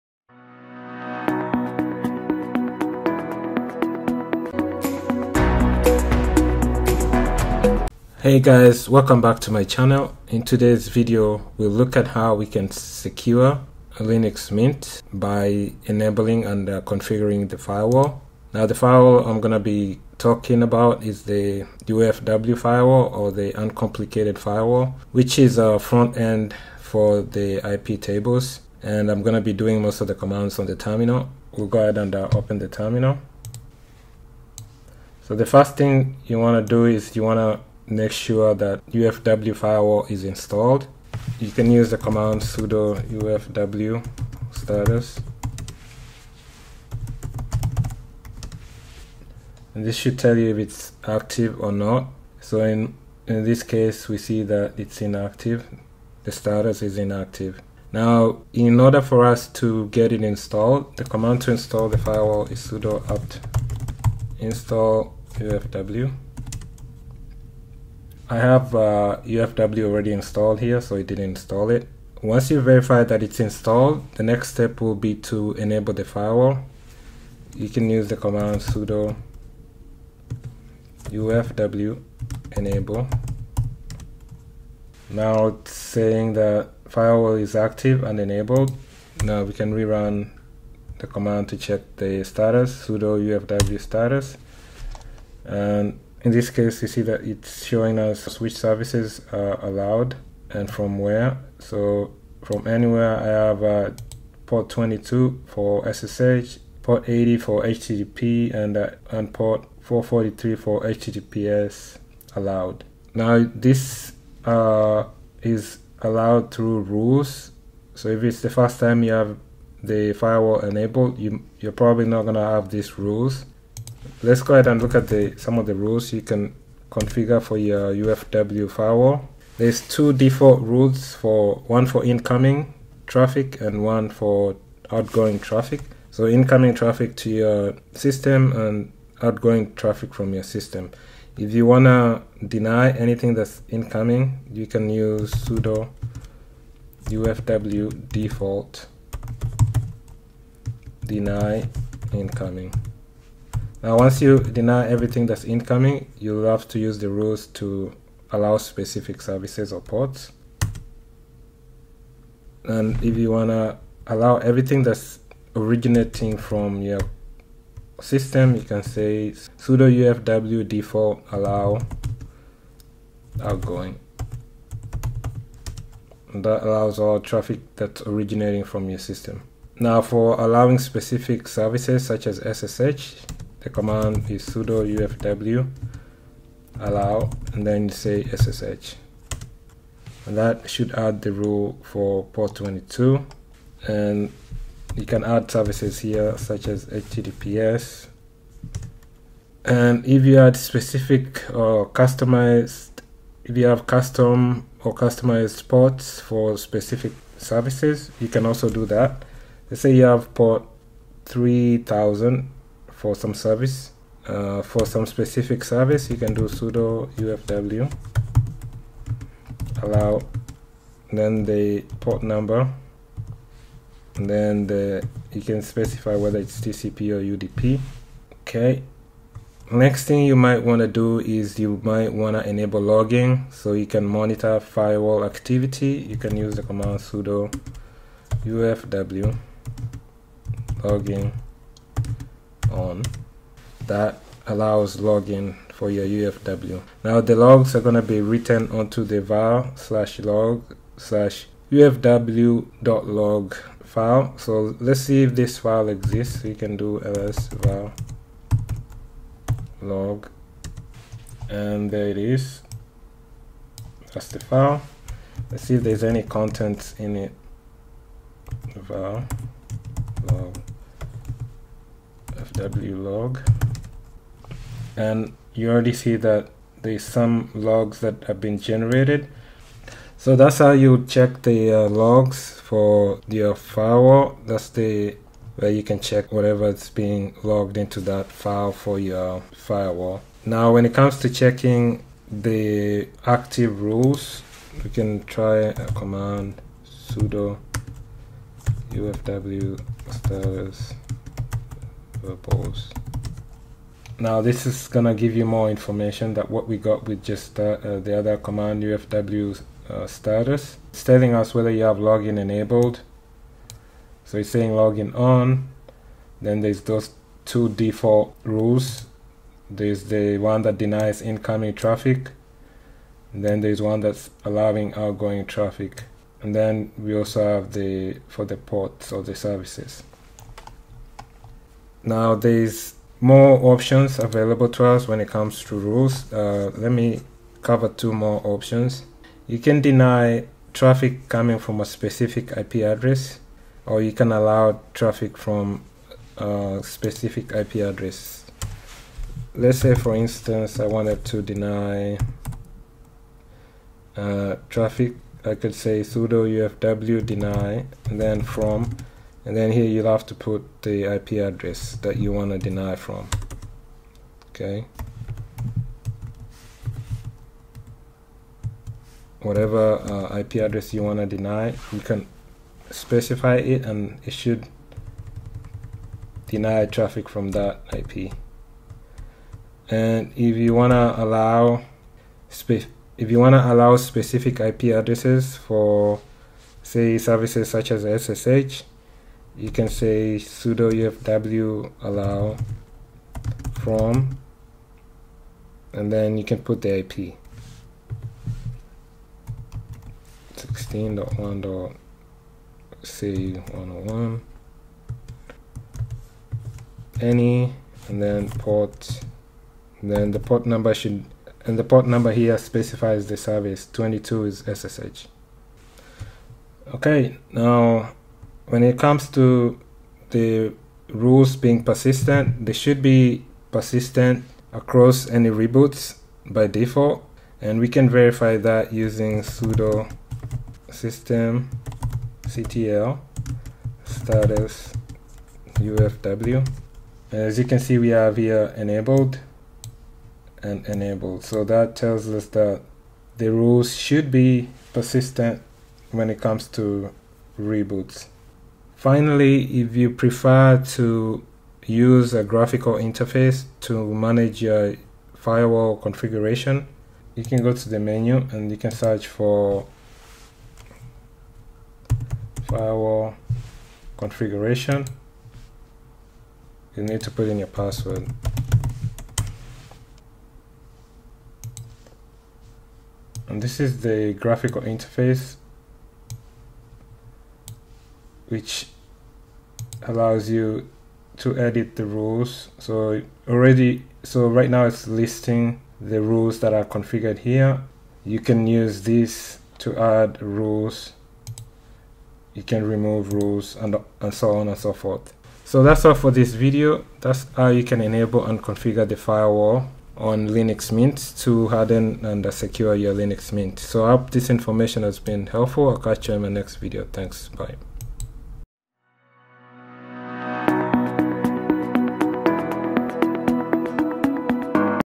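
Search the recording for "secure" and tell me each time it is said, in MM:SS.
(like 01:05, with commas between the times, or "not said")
00:12, 08:22.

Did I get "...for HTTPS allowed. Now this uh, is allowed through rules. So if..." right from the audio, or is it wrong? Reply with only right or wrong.
right.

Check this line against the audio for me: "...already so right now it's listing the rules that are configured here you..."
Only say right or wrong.
right.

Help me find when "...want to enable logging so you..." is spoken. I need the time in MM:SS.
03:52.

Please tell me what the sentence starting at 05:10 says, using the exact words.
It's telling us whether you have login enabled.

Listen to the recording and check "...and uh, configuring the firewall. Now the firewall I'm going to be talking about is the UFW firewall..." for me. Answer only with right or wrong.
right.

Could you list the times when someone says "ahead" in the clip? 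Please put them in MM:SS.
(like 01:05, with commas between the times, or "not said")
00:31, 02:04.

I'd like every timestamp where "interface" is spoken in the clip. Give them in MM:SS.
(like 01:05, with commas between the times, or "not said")
07:32, 07:54.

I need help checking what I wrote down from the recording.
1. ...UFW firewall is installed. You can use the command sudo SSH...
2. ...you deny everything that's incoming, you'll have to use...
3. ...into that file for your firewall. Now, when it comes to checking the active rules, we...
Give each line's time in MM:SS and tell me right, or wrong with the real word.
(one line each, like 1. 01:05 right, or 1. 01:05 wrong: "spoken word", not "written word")
1. 00:38 wrong: "UFW", not "SSH"
2. 02:34 right
3. 04:47 right.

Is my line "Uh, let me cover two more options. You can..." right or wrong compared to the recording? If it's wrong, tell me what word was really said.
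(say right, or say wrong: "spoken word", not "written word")
right.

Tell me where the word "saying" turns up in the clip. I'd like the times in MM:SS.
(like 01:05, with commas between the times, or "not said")
01:25, 05:14.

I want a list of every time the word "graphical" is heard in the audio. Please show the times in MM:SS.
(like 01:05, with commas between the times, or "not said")
07:32, 07:54.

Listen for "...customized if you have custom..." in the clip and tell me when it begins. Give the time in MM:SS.
03:21.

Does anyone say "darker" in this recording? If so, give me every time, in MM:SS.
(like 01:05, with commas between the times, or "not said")
not said.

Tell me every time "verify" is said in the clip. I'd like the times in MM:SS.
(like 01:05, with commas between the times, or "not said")
01:12, 07:08.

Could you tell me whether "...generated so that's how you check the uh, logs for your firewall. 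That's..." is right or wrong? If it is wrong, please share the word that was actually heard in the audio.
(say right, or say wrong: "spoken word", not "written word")
right.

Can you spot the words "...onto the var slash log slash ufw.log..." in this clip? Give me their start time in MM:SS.
04:08.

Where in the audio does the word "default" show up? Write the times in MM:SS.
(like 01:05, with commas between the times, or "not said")
02:10, 02:28, 02:50, 05:17, 07:06.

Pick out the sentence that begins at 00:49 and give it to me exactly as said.
And this should tell you if it's active or not.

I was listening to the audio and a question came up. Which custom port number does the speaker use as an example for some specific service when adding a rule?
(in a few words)
3000.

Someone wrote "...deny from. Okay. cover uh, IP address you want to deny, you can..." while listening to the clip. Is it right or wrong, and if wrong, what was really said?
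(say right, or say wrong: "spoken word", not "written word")
wrong: "whatever", not "cover".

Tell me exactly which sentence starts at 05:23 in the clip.
And then there's one that's allowing outgoing traffic.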